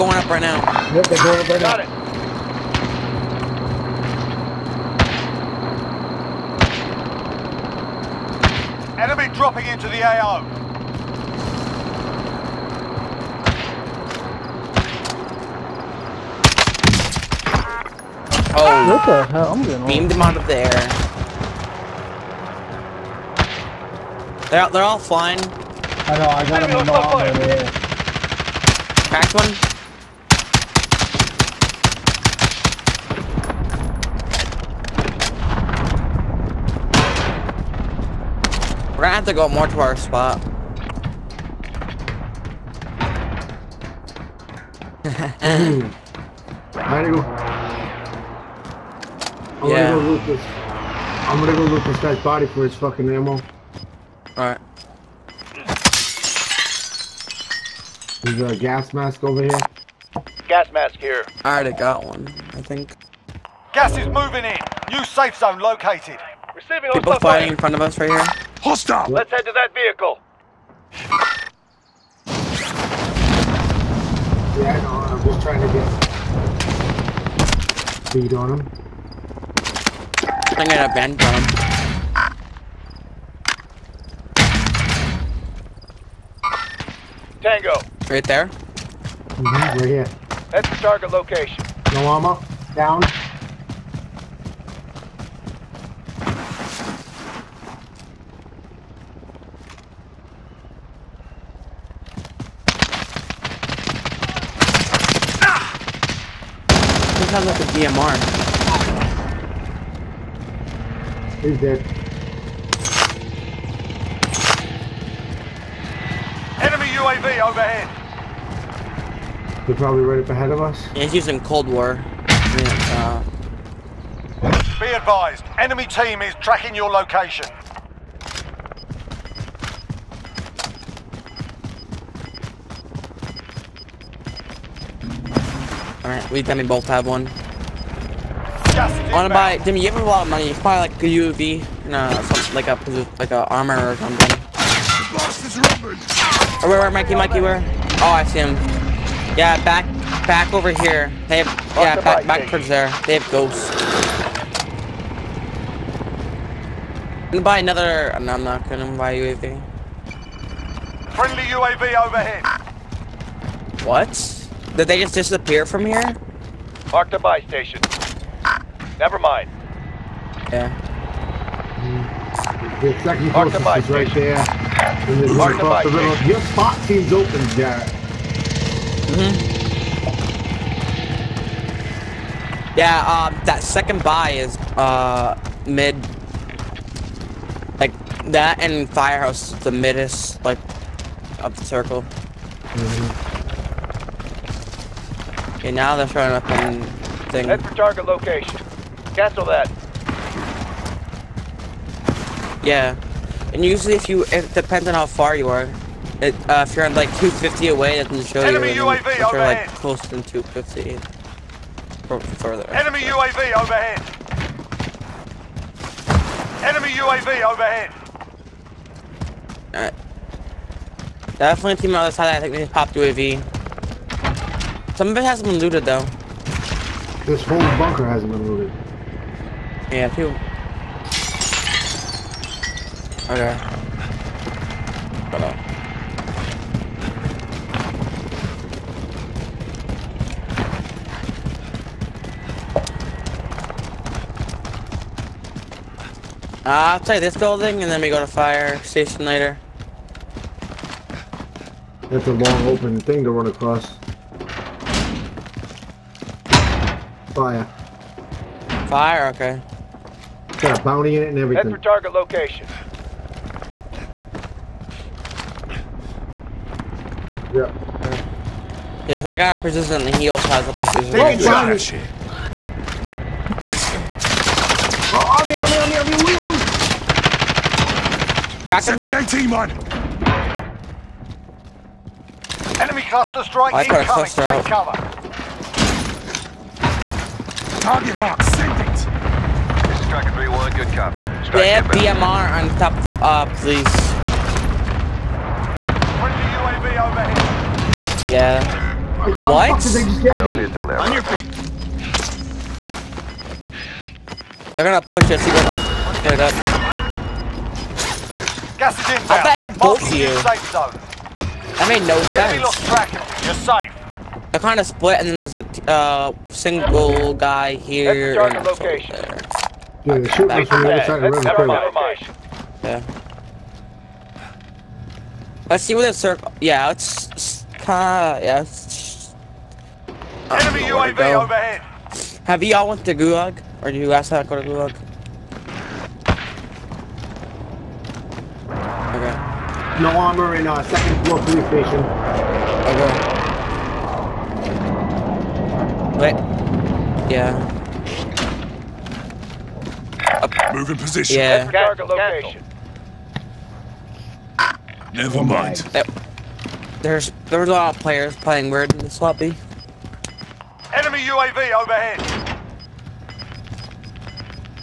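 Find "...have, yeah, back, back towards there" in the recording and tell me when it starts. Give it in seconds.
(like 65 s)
151 s.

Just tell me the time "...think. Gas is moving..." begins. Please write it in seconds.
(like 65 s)
62 s.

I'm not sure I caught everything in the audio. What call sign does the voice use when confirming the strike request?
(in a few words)
Tracker 3-1.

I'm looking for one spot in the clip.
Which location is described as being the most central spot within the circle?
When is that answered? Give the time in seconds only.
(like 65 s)
188 s.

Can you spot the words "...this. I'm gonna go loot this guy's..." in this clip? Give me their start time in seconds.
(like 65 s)
50 s.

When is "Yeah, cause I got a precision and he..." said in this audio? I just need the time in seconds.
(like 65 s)
269 s.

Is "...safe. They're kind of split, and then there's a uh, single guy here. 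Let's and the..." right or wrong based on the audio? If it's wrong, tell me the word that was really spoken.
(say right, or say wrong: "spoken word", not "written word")
right.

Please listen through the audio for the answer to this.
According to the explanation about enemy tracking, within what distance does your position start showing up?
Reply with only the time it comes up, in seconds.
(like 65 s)
207 s.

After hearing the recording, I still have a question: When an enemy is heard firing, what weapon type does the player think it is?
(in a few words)
DMR.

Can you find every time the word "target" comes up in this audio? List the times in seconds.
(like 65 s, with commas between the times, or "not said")
90 s, 197 s, 261 s, 287 s, 351 s.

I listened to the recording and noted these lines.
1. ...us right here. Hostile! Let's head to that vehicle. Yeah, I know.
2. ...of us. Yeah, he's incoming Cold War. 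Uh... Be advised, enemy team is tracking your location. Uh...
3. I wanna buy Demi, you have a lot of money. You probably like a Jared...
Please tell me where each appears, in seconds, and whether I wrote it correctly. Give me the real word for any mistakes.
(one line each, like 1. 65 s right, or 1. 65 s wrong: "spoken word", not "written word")
1. 67 s right
2. 120 s wrong: "using", not "incoming"
3. 138 s wrong: "UAV", not "Jared".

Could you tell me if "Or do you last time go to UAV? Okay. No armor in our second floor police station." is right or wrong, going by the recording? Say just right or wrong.
wrong.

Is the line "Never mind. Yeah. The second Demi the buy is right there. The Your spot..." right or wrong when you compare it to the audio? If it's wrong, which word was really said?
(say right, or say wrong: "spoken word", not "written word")
wrong: "Mark", not "Demi".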